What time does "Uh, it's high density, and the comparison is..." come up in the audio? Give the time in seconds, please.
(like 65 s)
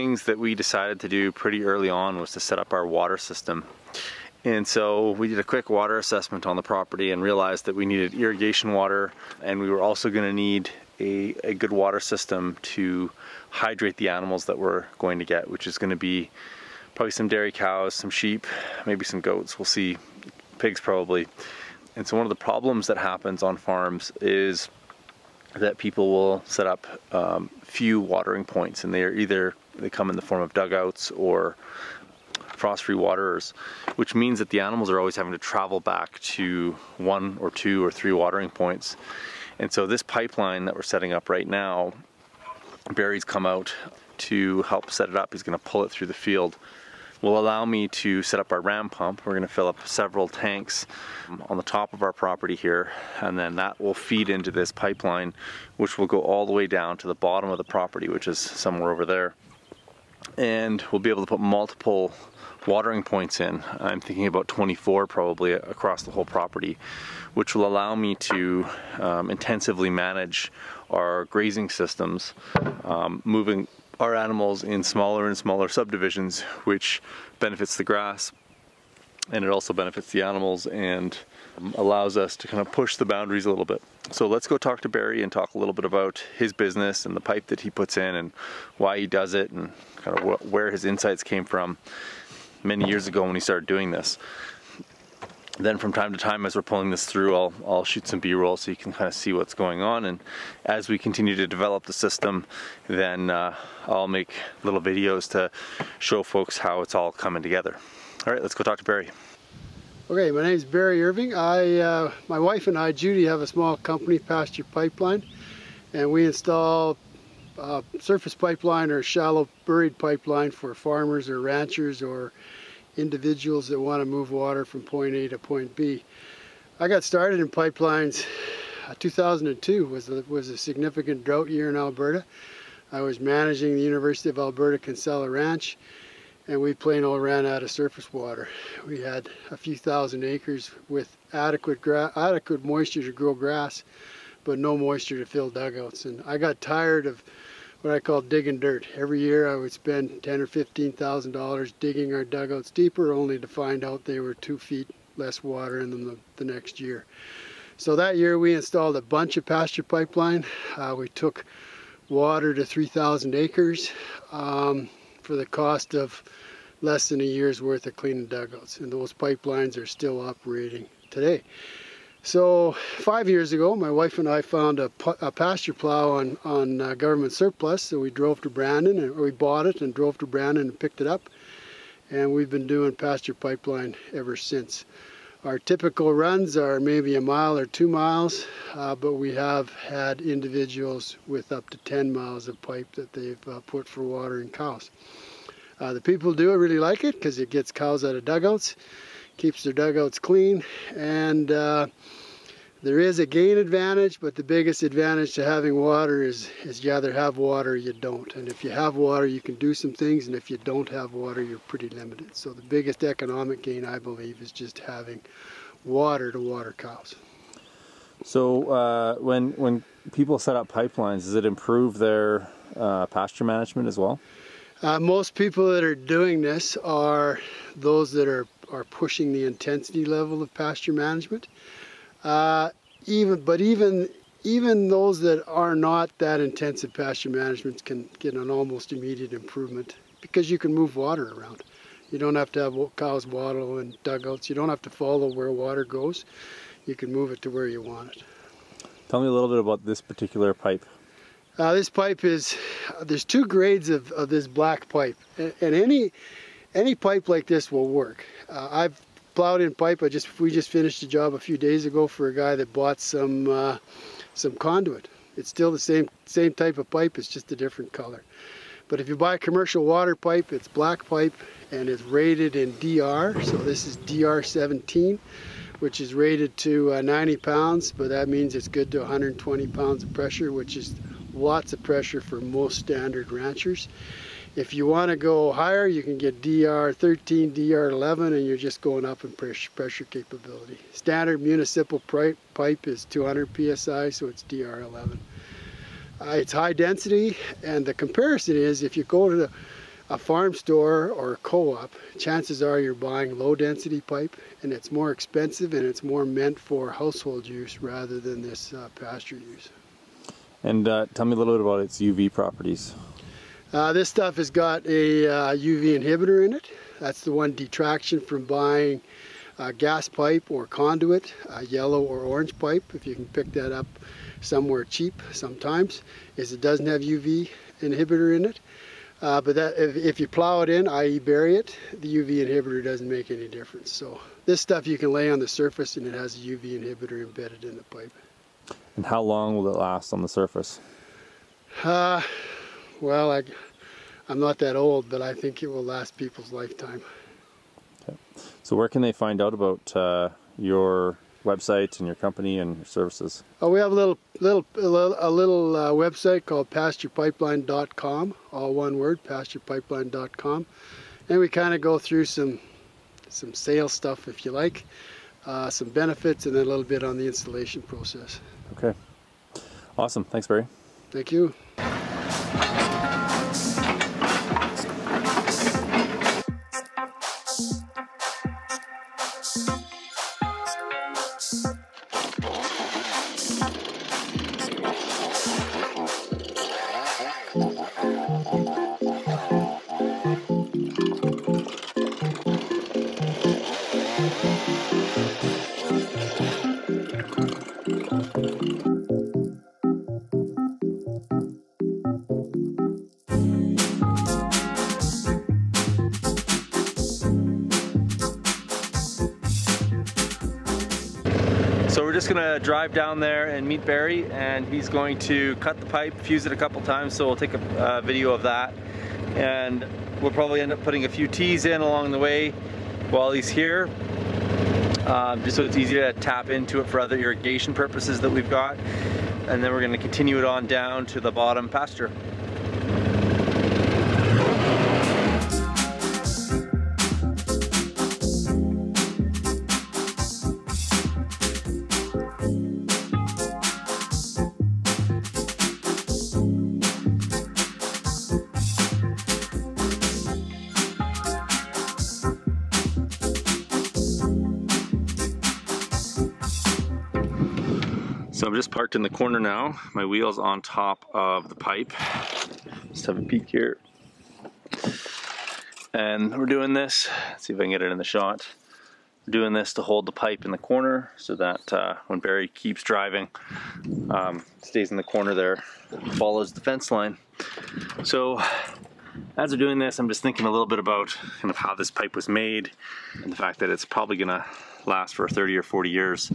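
296 s.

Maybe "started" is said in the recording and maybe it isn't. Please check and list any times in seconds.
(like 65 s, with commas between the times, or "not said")
93 s, 127 s.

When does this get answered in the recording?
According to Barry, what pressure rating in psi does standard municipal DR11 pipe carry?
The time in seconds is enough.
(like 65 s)
293 s.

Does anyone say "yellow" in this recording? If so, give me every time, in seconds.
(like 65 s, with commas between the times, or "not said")
321 s.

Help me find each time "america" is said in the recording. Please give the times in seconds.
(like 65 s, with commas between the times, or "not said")
not said.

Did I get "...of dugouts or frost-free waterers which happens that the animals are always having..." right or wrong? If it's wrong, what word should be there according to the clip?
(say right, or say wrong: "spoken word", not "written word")
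wrong: "means", not "happens".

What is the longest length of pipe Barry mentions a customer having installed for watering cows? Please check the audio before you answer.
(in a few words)
10 miles.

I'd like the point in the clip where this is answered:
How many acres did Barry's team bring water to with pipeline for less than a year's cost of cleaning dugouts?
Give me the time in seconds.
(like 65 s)
162 s.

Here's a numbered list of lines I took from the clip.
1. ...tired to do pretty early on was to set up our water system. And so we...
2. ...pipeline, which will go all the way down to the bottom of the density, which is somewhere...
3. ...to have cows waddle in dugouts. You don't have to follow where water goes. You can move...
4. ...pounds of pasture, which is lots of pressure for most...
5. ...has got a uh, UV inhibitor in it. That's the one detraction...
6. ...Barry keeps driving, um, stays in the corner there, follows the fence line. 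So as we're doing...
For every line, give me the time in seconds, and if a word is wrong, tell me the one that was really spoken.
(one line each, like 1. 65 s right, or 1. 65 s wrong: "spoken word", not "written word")
1. 0 s wrong: "decided", not "tired"
2. 54 s wrong: "property", not "density"
3. 242 s right
4. 279 s wrong: "pressure", not "pasture"
5. 314 s right
6. 472 s right.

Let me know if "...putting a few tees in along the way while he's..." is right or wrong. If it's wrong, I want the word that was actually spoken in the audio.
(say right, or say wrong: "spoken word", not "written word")
right.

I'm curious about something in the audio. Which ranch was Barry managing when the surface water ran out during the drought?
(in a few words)
Kinsella Ranch.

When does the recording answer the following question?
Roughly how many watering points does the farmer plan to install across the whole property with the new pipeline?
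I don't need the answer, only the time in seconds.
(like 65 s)
64 s.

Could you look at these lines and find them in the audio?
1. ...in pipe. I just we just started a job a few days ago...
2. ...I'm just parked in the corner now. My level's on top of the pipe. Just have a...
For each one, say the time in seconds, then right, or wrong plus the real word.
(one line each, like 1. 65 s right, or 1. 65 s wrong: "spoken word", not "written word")
1. 259 s wrong: "finished", not "started"
2. 458 s wrong: "wheel", not "level".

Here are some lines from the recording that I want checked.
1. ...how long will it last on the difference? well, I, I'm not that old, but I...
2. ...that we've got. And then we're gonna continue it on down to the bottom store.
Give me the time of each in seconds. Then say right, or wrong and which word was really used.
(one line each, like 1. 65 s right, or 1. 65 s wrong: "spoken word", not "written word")
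1. 339 s wrong: "surface", not "difference"
2. 428 s wrong: "pasture", not "store".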